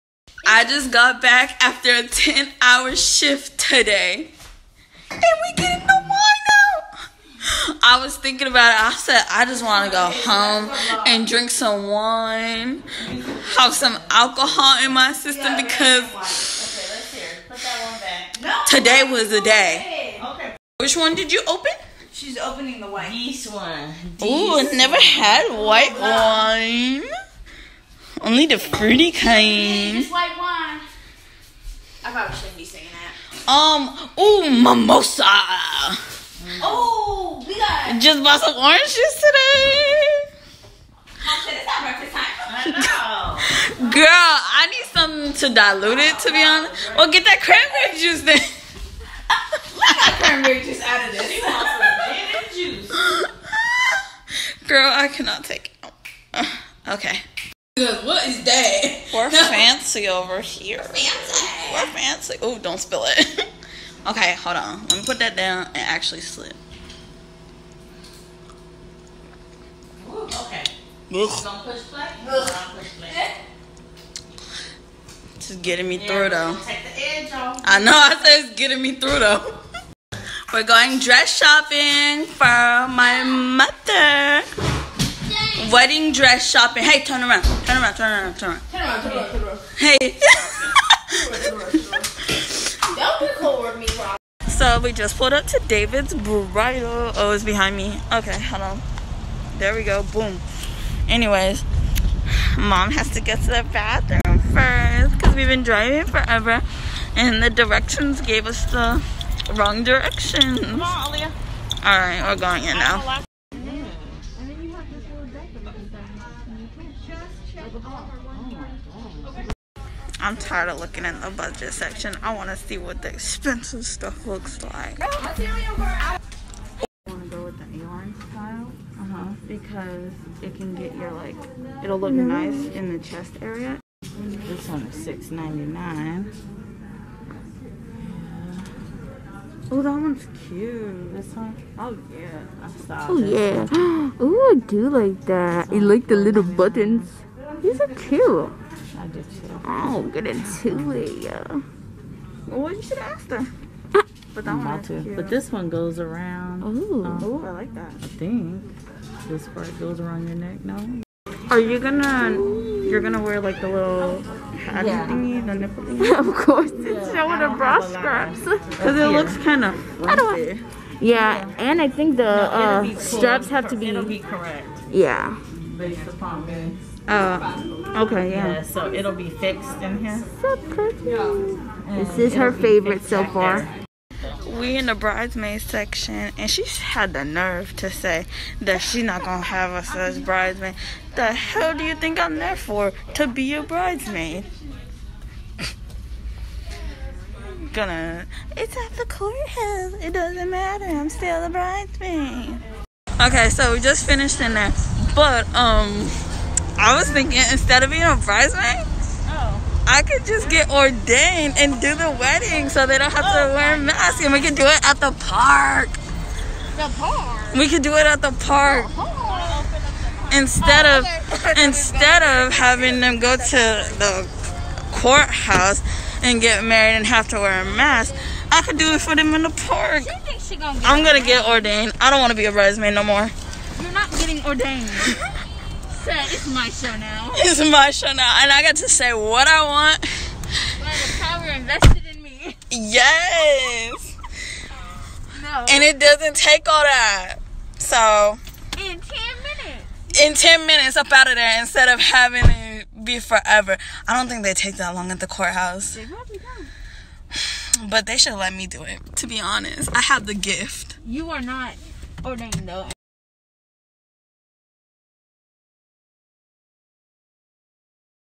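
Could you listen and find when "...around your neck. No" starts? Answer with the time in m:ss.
2:40.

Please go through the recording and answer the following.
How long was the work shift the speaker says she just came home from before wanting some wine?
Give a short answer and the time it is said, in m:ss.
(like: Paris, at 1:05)
10 hours, at 0:02.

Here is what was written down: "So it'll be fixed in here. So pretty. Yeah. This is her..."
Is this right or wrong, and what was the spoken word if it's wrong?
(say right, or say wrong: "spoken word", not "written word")
right.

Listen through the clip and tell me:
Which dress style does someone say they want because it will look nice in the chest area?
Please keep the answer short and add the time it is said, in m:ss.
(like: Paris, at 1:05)
A-line, at 2:07.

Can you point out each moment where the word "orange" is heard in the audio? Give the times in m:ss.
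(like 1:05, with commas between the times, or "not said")
0:38.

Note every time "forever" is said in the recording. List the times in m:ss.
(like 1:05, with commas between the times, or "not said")
1:46, 4:13.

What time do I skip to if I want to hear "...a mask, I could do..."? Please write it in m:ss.
3:47.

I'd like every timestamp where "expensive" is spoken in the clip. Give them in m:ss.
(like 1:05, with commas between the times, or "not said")
2:03.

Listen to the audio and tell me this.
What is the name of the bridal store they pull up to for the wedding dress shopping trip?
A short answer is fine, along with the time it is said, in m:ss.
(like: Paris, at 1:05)
David's Bridal, at 1:35.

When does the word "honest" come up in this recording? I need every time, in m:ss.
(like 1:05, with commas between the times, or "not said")
0:46, 4:19.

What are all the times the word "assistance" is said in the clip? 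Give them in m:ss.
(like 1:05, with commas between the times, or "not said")
not said.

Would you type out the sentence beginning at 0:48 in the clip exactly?
got cranberry juice out of this.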